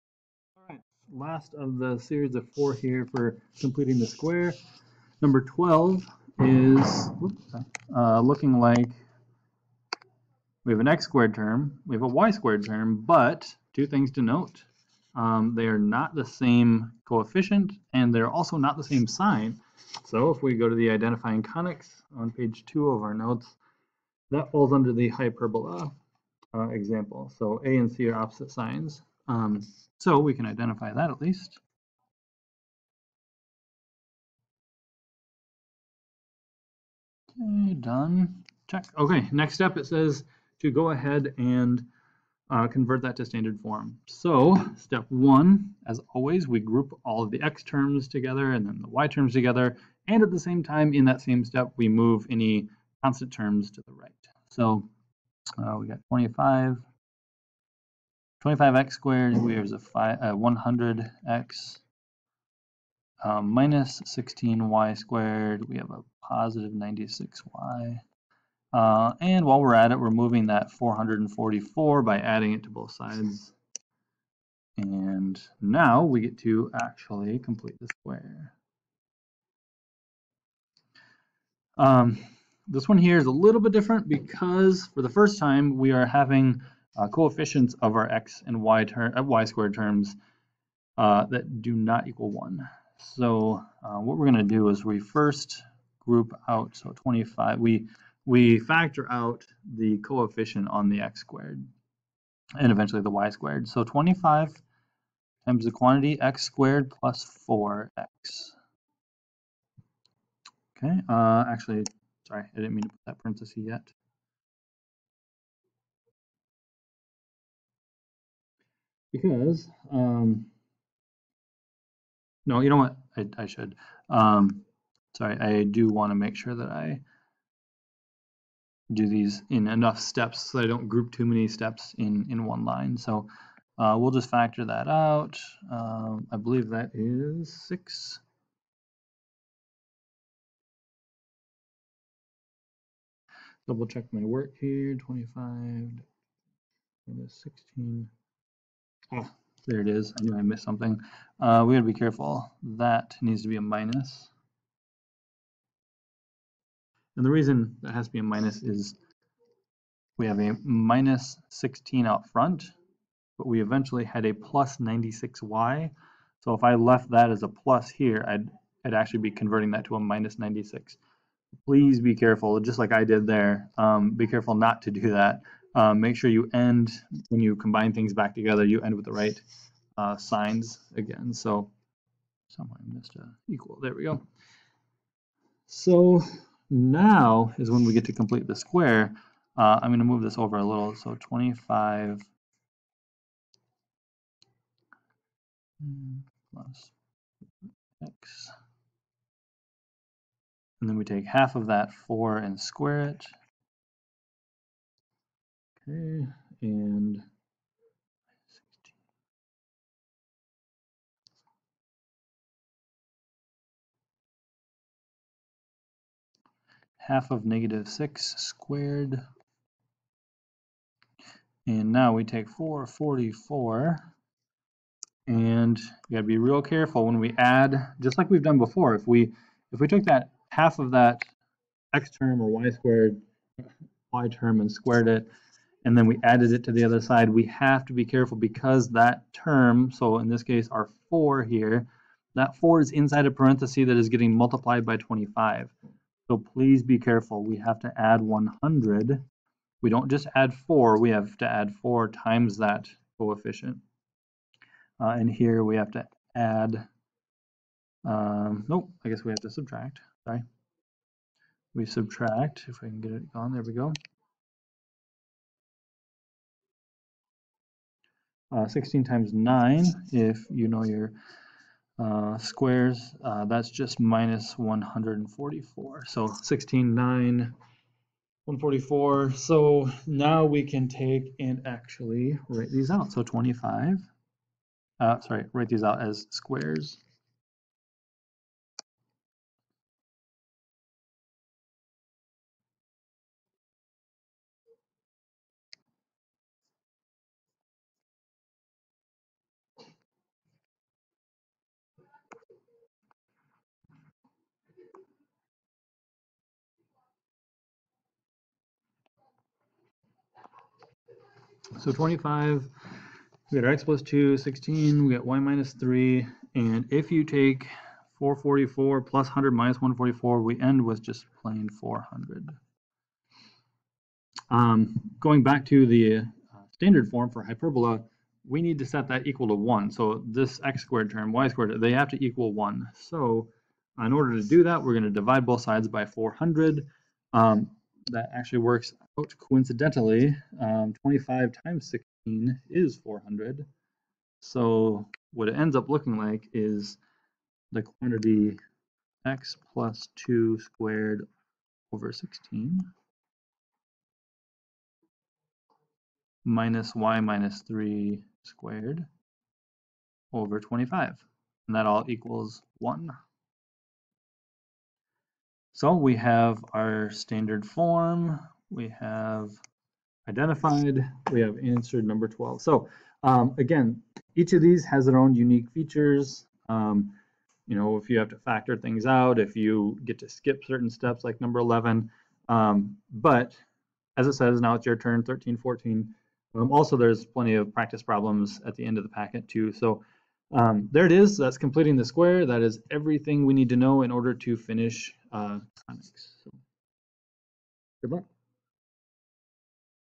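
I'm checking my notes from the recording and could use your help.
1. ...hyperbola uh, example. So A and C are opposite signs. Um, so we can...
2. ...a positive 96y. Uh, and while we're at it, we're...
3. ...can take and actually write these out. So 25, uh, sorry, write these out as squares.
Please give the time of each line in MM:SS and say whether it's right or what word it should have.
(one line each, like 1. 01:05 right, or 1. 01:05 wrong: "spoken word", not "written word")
1. 00:25 right
2. 01:05 right
3. 04:40 right.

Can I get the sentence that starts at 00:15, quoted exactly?
Um, they are not the same coefficient, and they're also not the same sign.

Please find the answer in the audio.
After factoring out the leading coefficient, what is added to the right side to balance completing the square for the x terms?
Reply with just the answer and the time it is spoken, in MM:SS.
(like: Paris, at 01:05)
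100, at 04:07.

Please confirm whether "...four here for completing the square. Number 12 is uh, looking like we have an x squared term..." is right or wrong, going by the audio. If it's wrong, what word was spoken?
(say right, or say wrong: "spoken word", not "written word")
right.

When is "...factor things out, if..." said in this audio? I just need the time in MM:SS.
06:18.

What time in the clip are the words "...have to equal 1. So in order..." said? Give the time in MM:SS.
05:31.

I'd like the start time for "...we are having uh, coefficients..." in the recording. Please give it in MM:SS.
01:25.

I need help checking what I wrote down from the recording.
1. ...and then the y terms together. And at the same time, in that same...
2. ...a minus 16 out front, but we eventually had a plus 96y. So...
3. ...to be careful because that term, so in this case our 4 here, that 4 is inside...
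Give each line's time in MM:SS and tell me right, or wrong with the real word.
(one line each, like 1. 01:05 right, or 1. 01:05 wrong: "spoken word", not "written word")
1. 00:48 right
2. 02:40 right
3. 03:57 right.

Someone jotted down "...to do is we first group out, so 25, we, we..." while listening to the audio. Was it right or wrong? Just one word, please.
right.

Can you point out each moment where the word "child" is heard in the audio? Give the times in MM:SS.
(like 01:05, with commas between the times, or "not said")
not said.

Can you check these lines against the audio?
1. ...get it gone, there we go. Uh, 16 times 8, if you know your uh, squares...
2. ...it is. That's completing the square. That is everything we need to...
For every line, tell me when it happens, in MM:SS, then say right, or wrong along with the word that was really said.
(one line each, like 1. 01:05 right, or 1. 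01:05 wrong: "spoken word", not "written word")
1. 04:23 wrong: "9", not "8"
2. 06:31 right.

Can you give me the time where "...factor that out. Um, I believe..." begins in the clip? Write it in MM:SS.
02:14.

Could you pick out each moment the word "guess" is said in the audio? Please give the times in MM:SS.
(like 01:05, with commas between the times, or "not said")
04:19.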